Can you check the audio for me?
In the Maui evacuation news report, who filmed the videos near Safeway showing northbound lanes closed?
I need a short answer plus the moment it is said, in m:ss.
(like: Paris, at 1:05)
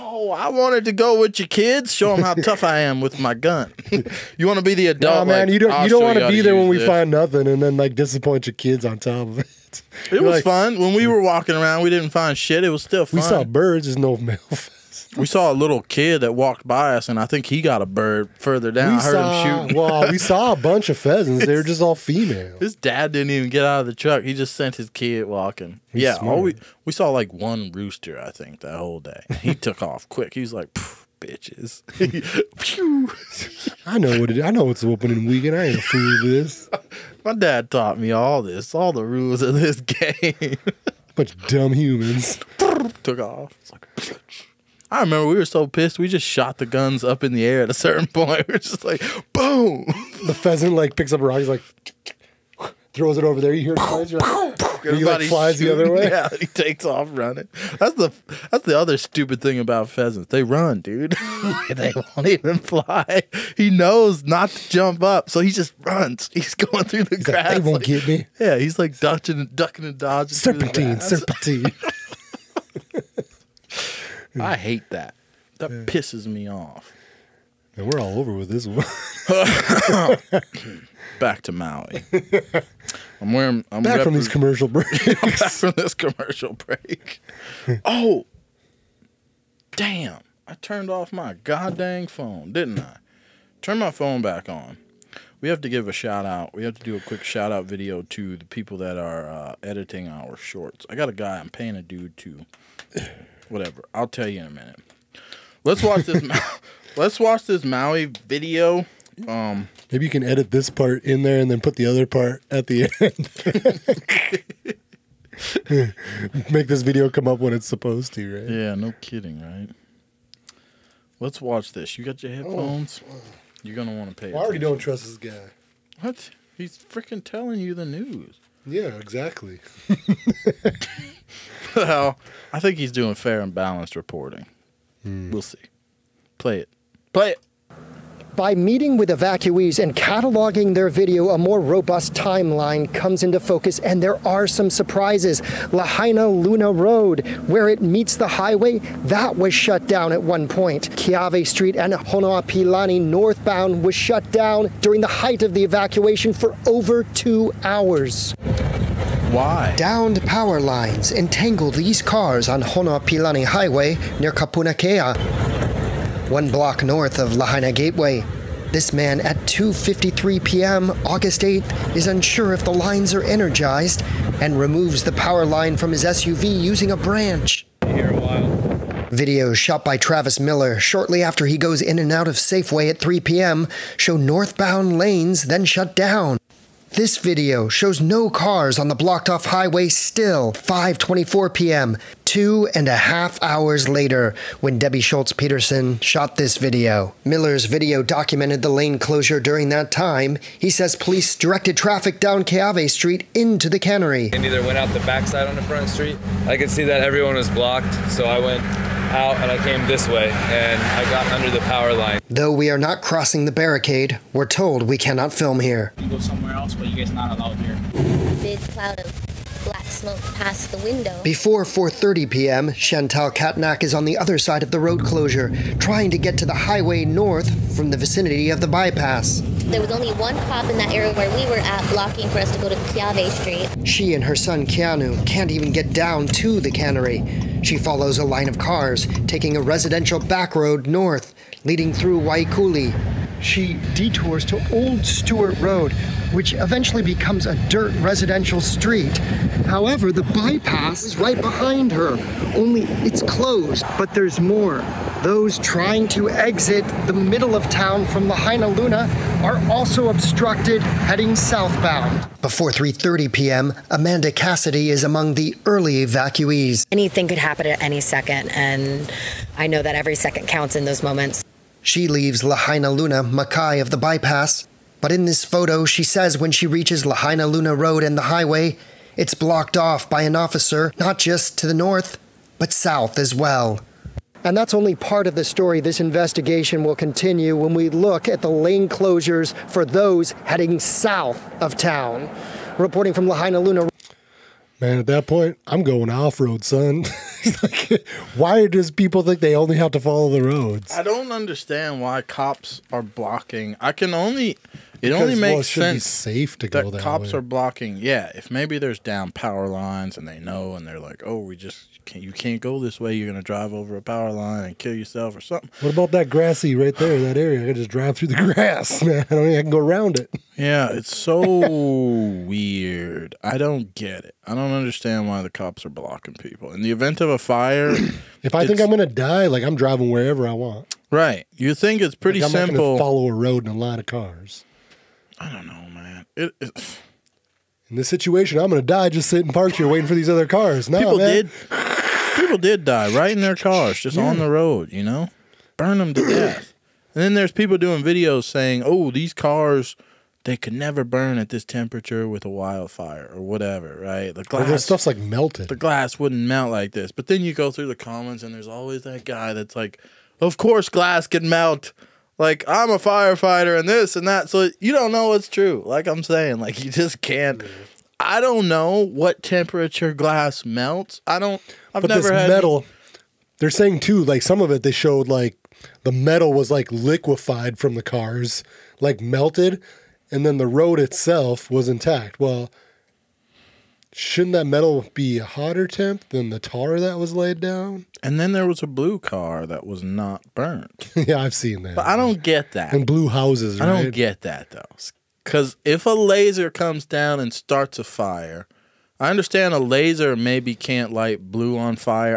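Travis Miller, at 2:59.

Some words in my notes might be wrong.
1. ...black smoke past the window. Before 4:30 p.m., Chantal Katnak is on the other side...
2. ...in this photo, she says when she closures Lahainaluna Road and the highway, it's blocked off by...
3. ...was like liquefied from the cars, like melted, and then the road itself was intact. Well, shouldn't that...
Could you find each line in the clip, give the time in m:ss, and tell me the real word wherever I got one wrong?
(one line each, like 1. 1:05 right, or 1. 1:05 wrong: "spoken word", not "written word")
1. 3:39 right
2. 4:35 wrong: "reaches", not "closures"
3. 6:16 right.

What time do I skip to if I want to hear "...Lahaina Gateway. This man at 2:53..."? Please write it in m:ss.
2:47.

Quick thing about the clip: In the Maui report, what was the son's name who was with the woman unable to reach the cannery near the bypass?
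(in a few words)
Keanu.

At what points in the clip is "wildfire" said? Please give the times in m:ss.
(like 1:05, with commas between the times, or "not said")
5:52.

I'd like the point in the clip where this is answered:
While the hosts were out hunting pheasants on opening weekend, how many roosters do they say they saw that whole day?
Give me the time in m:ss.
0:27.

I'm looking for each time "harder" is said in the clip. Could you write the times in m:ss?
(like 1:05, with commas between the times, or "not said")
not said.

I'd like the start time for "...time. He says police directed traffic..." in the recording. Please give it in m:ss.
3:19.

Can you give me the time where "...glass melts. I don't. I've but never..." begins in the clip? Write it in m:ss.
6:10.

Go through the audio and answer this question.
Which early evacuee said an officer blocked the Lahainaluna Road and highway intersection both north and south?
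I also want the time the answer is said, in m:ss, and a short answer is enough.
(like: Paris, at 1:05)
Amanda Cassidy, at 4:23.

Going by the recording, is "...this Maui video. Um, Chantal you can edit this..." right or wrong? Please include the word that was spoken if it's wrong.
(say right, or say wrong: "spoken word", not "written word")
wrong: "Maybe", not "Chantal".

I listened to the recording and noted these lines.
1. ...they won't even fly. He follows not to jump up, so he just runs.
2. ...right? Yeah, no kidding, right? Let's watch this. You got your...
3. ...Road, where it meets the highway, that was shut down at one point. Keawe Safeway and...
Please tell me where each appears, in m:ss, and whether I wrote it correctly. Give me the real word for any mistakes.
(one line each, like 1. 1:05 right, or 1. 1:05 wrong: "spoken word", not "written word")
1. 1:01 wrong: "knows", not "follows"
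2. 1:58 right
3. 2:26 wrong: "Street", not "Safeway".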